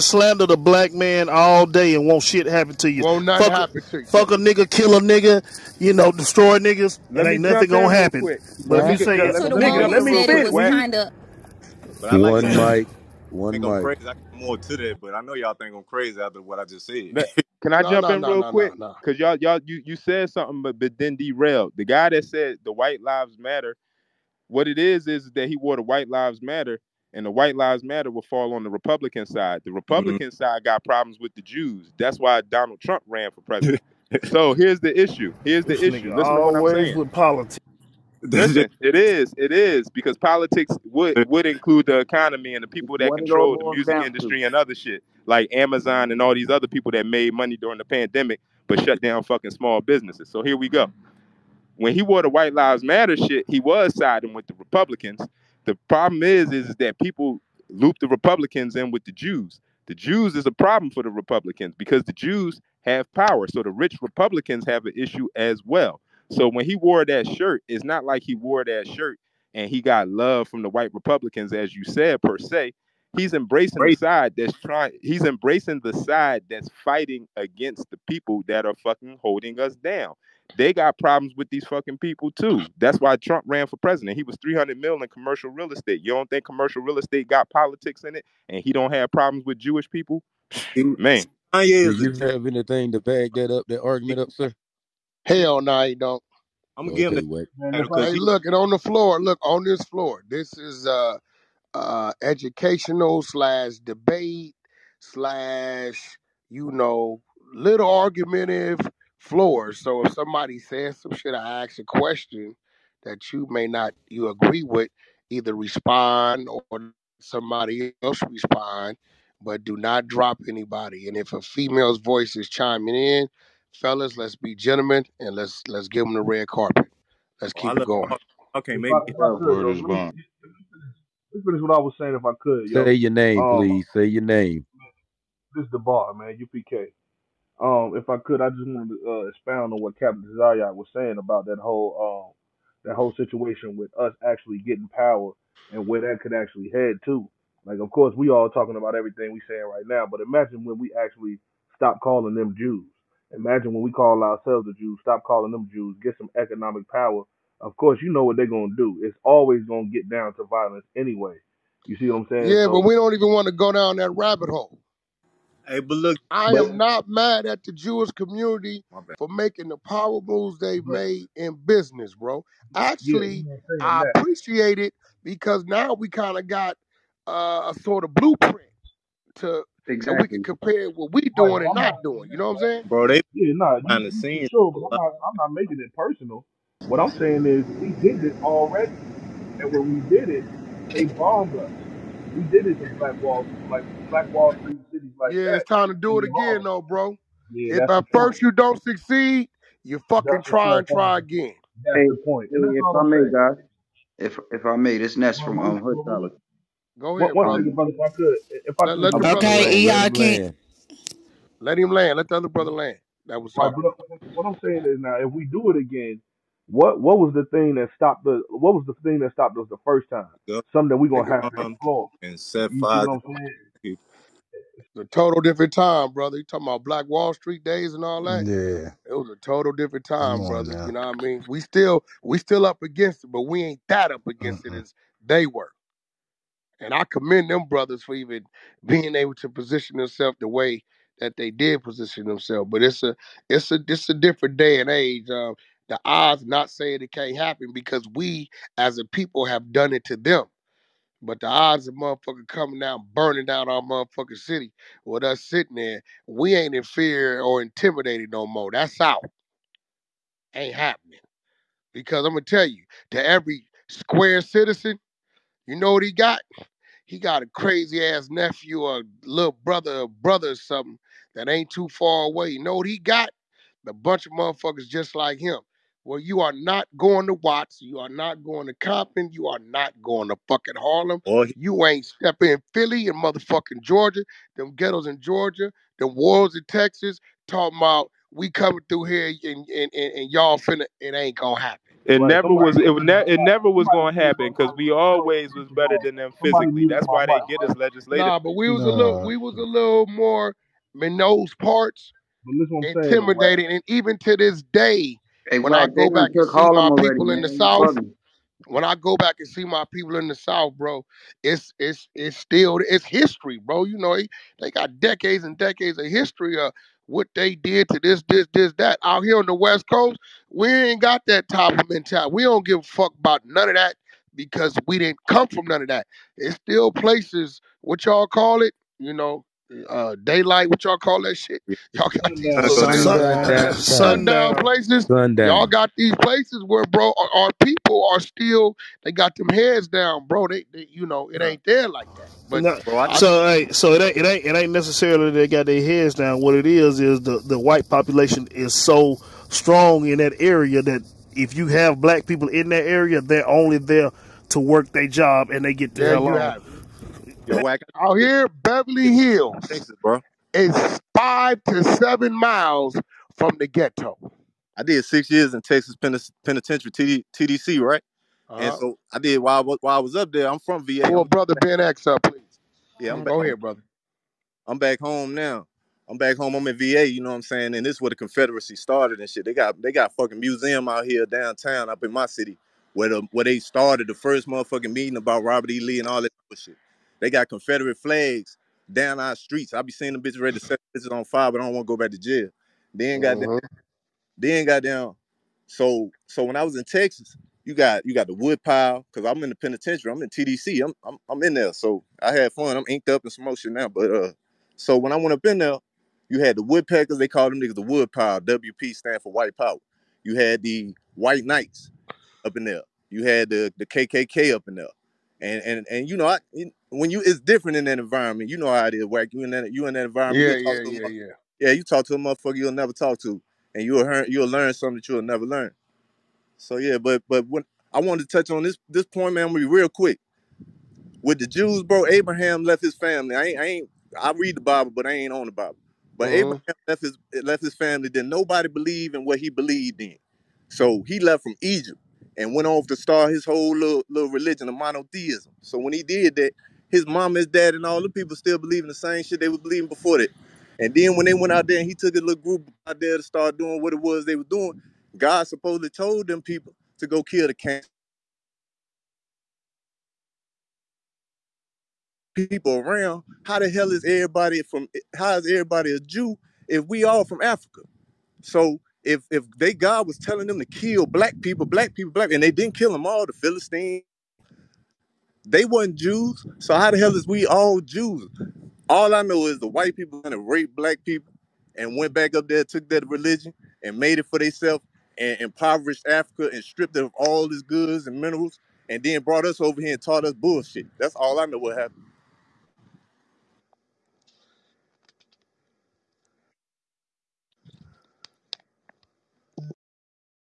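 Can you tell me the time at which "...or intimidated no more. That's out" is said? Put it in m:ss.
4:17.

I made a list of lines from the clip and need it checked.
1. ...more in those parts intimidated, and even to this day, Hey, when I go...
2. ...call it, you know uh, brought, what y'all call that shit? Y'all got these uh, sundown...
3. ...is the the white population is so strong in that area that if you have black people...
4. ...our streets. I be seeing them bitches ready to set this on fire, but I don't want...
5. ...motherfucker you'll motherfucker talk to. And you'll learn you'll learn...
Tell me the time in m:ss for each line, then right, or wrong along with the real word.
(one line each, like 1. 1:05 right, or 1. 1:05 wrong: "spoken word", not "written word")
1. 5:00 right
2. 5:28 wrong: "daylight", not "brought"
3. 5:46 right
4. 6:29 right
5. 7:02 wrong: "never", not "motherfucker".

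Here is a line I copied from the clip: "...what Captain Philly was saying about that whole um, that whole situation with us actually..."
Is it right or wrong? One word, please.
wrong.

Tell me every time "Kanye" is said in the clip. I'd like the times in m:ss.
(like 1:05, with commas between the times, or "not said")
1:31.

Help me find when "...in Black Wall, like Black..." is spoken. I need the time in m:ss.
3:12.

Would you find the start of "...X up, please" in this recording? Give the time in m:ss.
6:11.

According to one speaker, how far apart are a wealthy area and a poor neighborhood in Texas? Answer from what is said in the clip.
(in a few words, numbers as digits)
5 to 7 miles.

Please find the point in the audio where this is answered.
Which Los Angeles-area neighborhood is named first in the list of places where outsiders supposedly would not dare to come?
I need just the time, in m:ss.
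4:37.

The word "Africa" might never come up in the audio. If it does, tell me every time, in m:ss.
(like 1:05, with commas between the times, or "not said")
7:47, 8:06.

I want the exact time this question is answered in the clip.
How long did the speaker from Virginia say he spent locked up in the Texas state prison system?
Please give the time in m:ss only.
6:05.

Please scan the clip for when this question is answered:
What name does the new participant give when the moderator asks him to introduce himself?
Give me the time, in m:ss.
2:16.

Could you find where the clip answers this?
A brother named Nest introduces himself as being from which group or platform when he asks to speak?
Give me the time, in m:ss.
3:25.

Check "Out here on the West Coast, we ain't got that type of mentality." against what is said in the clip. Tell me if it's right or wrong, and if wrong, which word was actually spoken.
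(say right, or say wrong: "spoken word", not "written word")
right.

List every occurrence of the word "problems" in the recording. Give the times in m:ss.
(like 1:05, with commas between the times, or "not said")
0:30, 0:55, 1:00, 1:20, 1:29.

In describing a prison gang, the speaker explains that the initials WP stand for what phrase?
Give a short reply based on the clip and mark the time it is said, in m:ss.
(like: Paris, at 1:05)
White power, at 6:49.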